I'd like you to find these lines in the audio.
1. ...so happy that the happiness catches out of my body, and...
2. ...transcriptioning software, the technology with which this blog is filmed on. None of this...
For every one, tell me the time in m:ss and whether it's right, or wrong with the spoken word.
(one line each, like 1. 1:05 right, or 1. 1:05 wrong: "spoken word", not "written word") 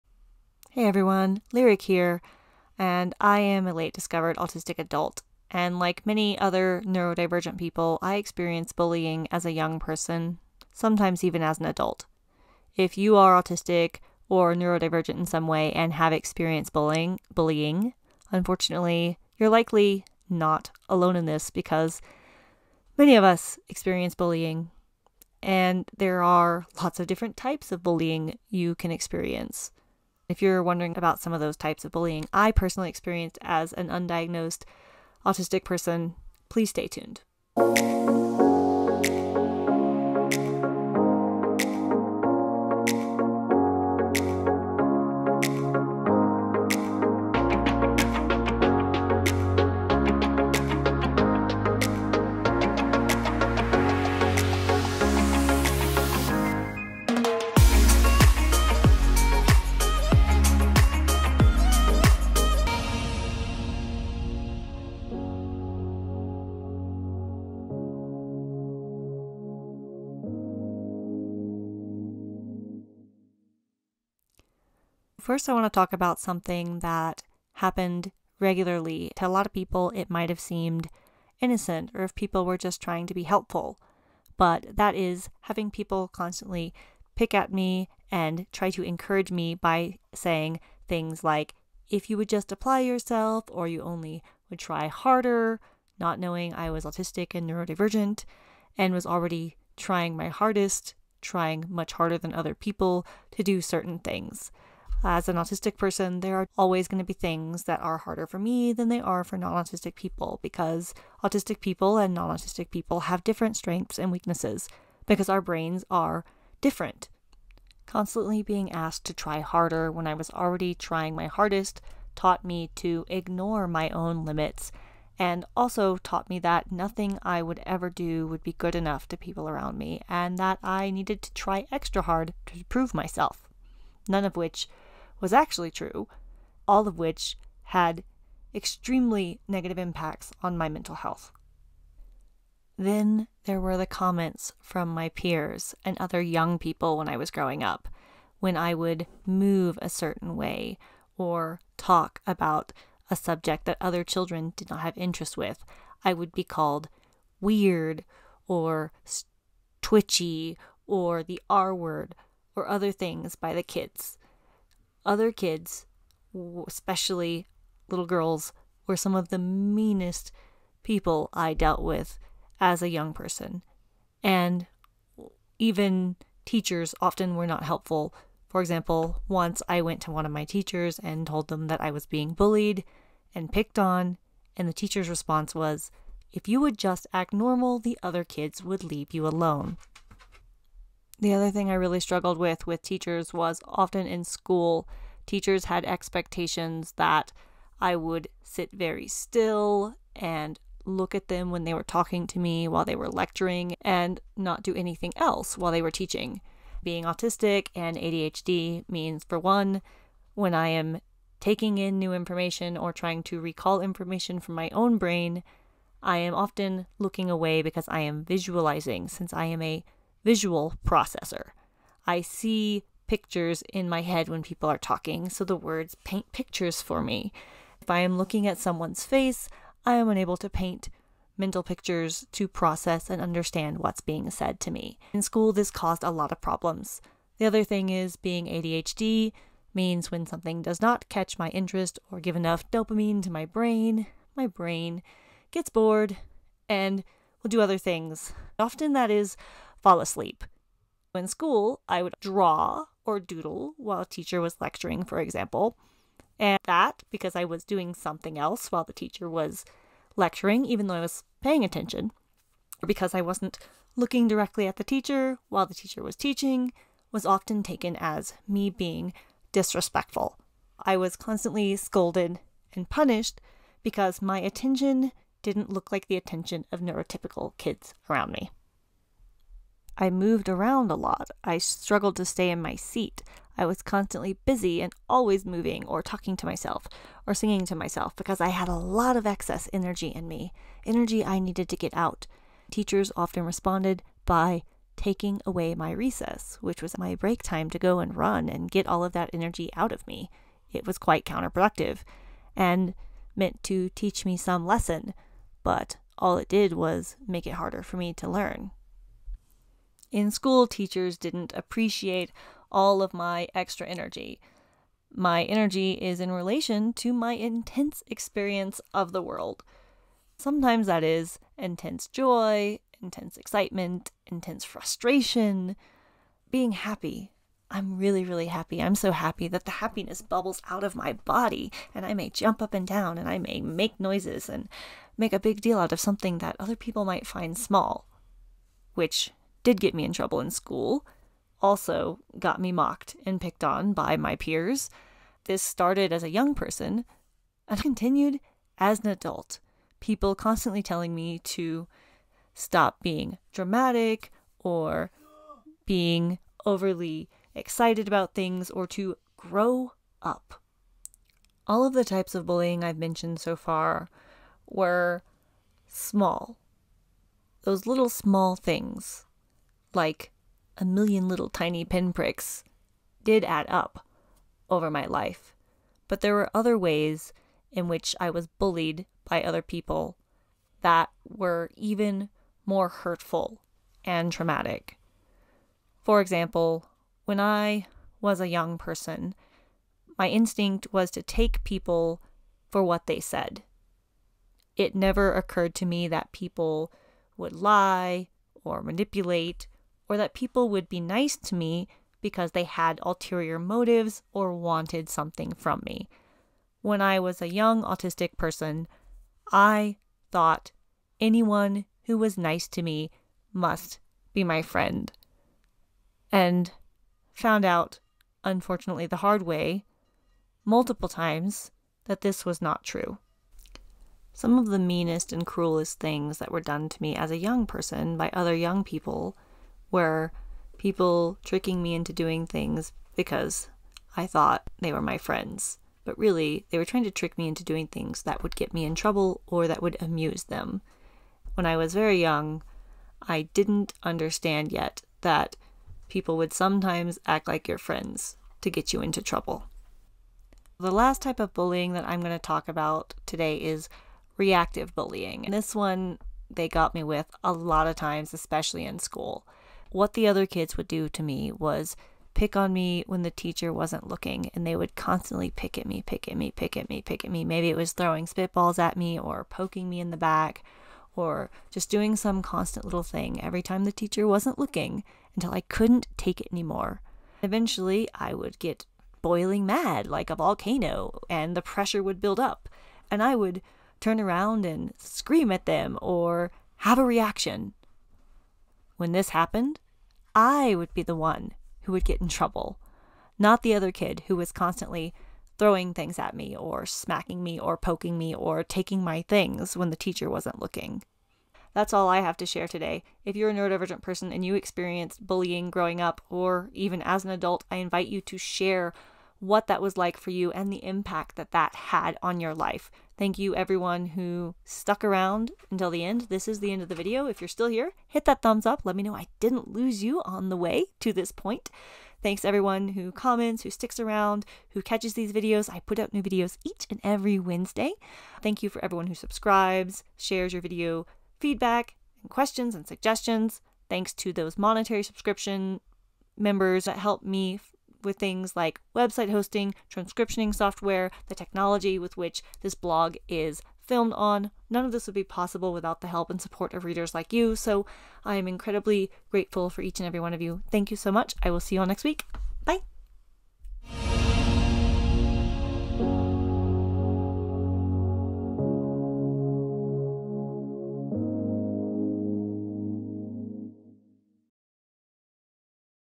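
1. 5:28 wrong: "bubbles", not "catches"
2. 8:59 right.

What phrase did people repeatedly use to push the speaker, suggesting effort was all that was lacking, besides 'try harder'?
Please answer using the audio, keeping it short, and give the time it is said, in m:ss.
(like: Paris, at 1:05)
apply yourself, at 1:32.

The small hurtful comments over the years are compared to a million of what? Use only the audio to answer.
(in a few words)
tiny pinpricks.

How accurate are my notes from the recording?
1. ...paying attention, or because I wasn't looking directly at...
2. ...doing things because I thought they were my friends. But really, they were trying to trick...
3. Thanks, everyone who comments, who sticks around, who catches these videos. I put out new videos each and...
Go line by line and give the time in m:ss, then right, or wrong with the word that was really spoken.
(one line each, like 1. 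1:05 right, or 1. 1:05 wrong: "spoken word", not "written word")
1. 4:21 right
2. 7:12 right
3. 8:42 right.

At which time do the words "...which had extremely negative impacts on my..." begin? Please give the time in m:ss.
2:16.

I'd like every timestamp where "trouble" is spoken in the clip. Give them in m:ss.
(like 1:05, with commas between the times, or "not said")
5:40, 7:18, 7:29, 8:12.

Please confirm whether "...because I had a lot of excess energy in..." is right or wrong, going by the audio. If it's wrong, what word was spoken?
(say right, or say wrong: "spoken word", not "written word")
right.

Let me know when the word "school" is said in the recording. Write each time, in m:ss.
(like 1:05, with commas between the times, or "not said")
3:14, 3:55, 4:11, 5:10, 5:40, 7:38.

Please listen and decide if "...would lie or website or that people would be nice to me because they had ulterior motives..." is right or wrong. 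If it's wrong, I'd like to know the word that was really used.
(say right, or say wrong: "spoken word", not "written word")
wrong: "manipulate", not "website".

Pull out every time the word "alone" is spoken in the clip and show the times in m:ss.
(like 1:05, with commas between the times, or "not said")
0:20, 3:09.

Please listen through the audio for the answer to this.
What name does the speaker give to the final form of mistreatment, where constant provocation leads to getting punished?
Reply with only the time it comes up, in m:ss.
7:34.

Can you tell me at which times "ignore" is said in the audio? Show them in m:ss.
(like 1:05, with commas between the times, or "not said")
2:03.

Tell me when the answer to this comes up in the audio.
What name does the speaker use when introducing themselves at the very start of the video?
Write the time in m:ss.
0:01.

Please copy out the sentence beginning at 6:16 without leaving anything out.
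But there were other ways in which I was bullied by other people that were even more hurtful and traumatic.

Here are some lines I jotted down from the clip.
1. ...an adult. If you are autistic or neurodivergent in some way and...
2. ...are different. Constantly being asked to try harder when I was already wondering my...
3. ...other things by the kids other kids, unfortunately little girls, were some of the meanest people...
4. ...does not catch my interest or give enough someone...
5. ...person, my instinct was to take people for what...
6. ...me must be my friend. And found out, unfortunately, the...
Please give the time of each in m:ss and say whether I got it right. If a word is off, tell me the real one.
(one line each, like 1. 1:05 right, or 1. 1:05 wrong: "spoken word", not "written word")
1. 0:11 right
2. 1:55 wrong: "trying", not "wondering"
3. 2:42 wrong: "especially", not "unfortunately"
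4. 4:00 wrong: "dopamine", not "someone"
5. 6:28 right
6. 6:52 right.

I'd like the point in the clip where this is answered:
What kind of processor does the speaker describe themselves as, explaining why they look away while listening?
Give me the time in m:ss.
3:40.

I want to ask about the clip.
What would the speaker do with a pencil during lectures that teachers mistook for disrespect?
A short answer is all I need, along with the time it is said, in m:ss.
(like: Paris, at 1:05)
draw or doodle, at 4:12.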